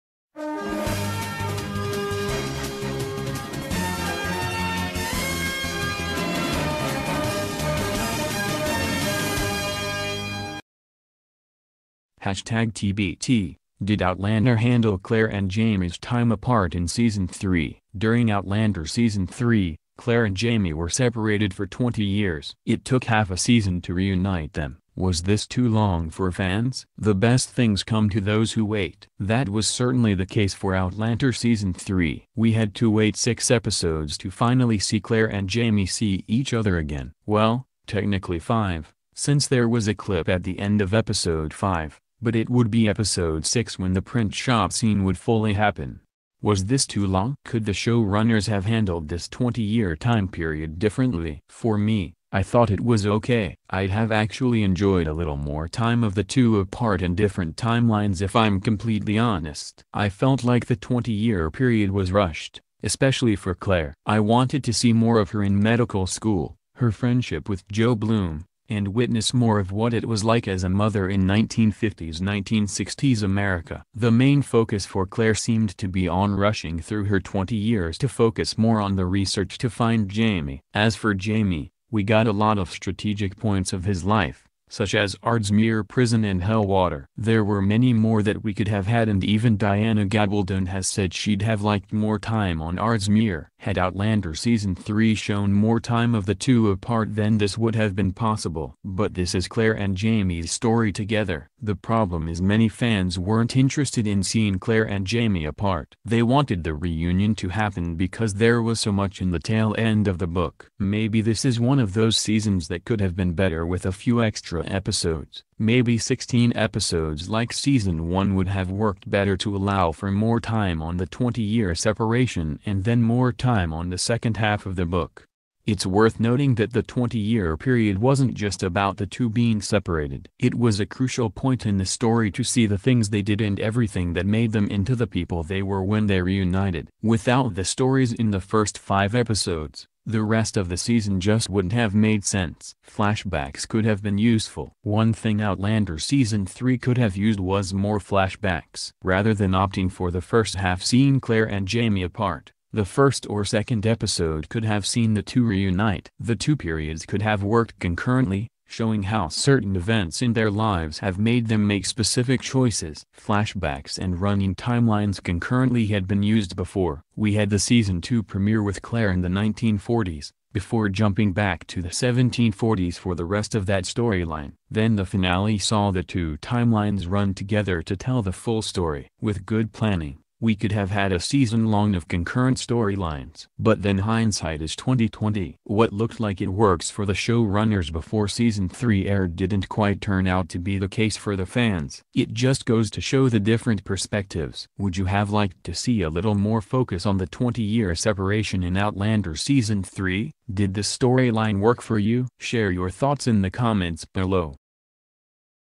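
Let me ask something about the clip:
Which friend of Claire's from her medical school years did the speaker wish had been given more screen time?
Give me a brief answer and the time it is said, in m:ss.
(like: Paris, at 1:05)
Joe Bloom, at 1:07.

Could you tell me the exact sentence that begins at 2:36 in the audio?
The two periods could have worked concurrently, showing how certain events in their lives have made them make specific choices.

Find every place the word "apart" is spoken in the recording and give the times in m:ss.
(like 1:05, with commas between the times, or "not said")
0:16, 0:56, 1:36, 1:45, 2:32.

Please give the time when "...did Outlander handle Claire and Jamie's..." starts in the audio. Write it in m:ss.
0:13.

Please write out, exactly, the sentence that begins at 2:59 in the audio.
With good planning, we could have had a season long of concurrent storylines.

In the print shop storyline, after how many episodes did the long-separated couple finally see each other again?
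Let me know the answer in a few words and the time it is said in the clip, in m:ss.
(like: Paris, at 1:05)
6, at 0:33.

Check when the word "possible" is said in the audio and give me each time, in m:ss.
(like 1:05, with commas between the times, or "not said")
1:38.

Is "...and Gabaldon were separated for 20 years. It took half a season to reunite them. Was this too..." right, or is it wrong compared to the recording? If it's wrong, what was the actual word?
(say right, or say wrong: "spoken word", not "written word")
wrong: "Jamie", not "Gabaldon".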